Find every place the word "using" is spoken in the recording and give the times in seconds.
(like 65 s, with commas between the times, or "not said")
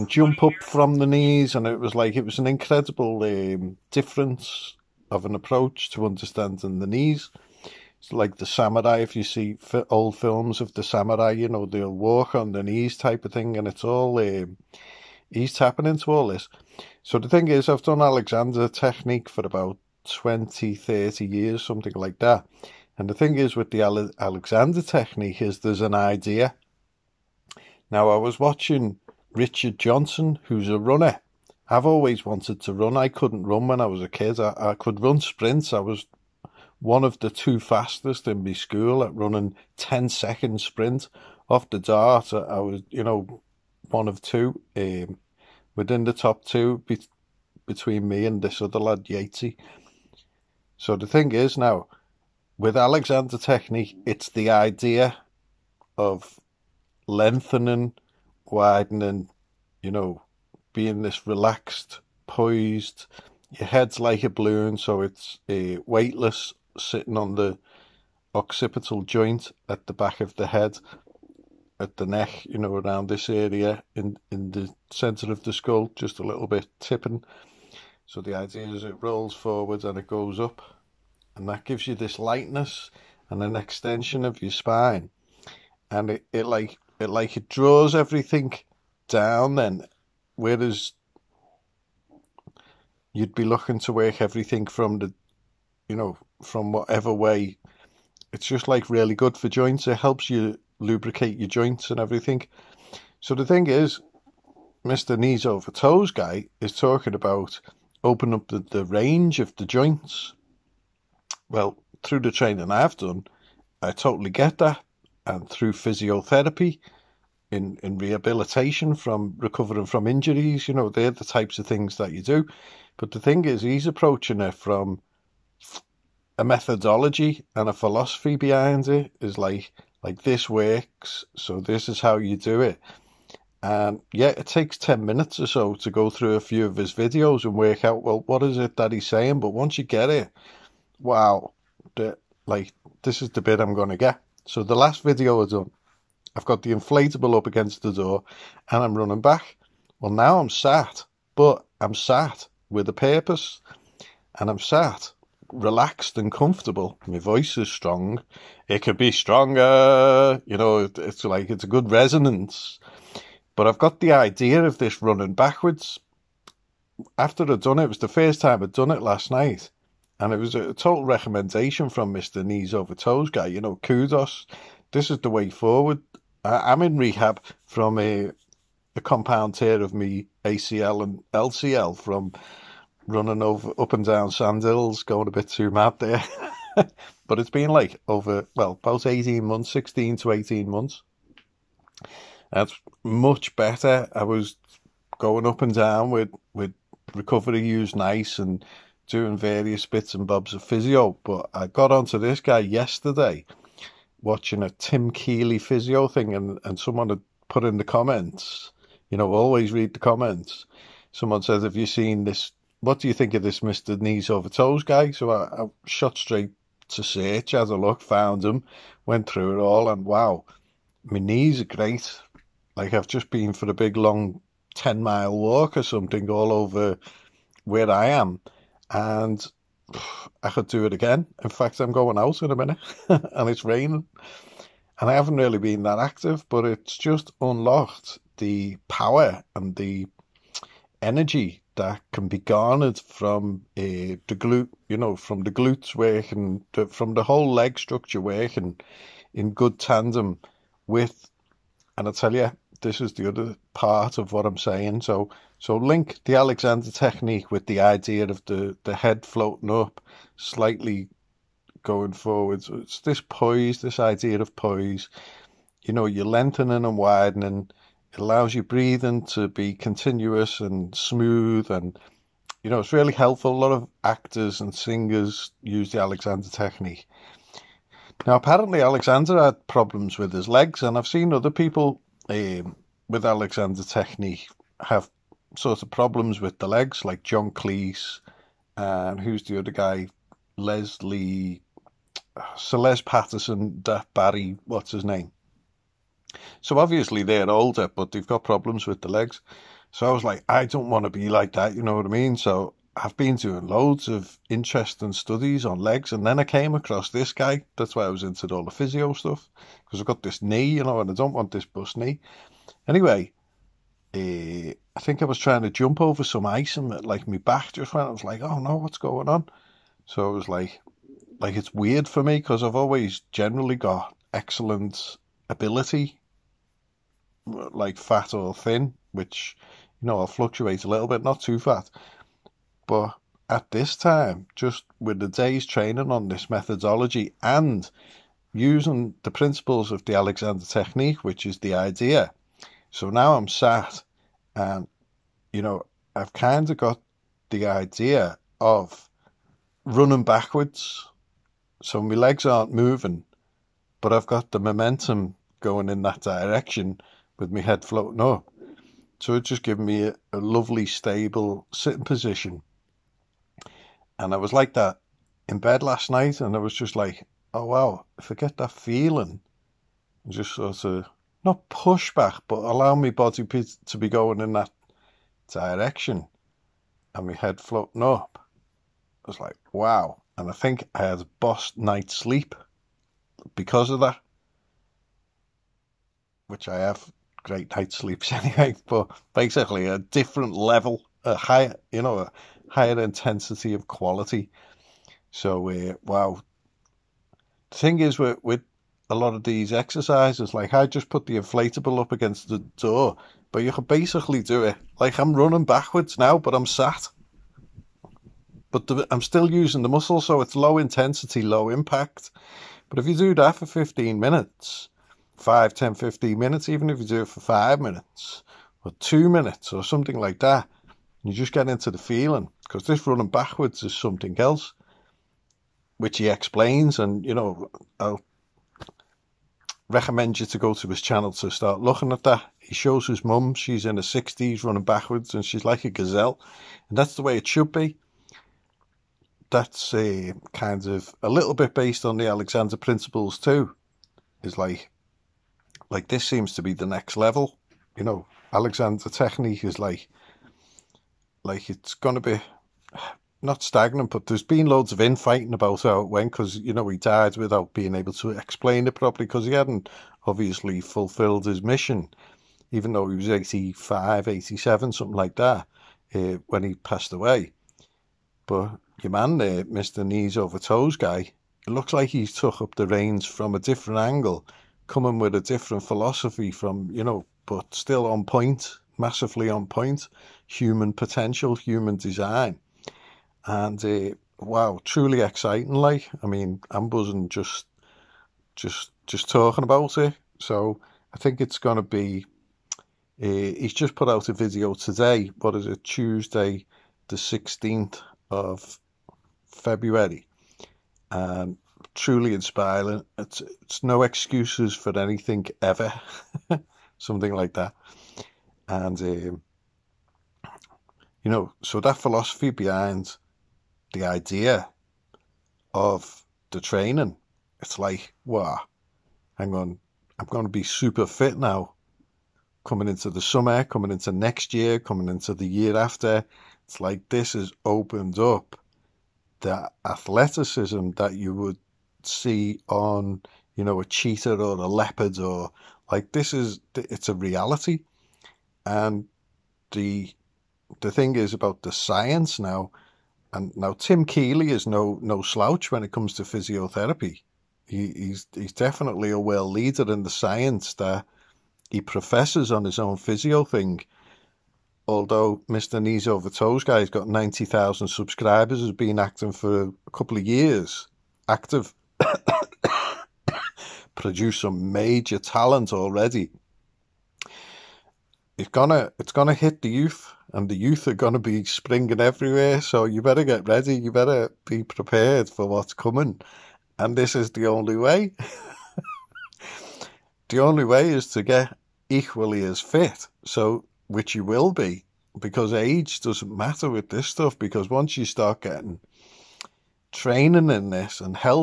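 338 s, 409 s.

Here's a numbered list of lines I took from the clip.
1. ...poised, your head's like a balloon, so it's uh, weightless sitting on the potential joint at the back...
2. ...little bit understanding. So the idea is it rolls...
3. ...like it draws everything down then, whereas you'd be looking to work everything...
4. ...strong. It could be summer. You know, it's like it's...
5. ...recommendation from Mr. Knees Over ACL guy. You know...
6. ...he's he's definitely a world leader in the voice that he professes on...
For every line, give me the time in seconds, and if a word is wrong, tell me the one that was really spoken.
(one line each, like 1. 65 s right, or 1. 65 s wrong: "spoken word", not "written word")
1. 62 s wrong: "occipital", not "potential"
2. 76 s wrong: "tipping", not "understanding"
3. 87 s right
4. 157 s wrong: "stronger", not "summer"
5. 171 s wrong: "Toes", not "ACL"
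6. 547 s wrong: "science", not "voice".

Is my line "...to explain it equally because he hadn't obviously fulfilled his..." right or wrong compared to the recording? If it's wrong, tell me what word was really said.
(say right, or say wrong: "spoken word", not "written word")
wrong: "properly", not "equally".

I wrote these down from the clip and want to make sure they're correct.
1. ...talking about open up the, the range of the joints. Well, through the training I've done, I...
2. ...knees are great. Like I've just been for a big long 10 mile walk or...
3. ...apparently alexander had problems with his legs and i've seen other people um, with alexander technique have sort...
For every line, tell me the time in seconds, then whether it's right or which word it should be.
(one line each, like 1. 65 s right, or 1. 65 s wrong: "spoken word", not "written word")
1. 106 s right
2. 221 s right
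3. 278 s right.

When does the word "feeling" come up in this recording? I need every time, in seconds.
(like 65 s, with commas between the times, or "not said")
368 s, 421 s.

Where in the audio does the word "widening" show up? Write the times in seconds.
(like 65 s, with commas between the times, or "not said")
58 s, 266 s.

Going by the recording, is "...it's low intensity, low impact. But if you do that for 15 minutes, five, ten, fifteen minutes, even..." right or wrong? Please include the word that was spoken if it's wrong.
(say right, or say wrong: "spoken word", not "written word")
right.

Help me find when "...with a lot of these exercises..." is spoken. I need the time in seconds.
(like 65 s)
398 s.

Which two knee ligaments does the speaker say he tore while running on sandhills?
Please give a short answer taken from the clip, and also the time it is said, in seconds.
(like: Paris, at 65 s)
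ACL and LCL, at 180 s.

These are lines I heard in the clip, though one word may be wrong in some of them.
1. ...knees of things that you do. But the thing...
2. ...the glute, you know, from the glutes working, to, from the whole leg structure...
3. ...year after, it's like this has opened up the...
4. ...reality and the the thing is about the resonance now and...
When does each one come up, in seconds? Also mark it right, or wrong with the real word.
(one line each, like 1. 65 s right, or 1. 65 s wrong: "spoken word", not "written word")
1. 121 s wrong: "types", not "knees"
2. 244 s right
3. 525 s right
4. 537 s wrong: "science", not "resonance".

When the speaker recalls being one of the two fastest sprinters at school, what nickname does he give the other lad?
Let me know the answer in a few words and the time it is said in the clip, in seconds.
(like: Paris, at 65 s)
Yatesy, at 49 s.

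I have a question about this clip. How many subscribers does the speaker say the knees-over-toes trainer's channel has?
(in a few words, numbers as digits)
90,000.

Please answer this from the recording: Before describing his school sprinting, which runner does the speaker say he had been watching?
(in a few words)
Richard Johnson.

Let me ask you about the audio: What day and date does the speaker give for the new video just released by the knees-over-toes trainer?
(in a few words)
Tuesday 16 February.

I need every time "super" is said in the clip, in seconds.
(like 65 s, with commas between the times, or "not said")
520 s.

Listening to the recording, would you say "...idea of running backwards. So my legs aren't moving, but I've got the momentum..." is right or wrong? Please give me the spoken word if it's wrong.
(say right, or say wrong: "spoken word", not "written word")
right.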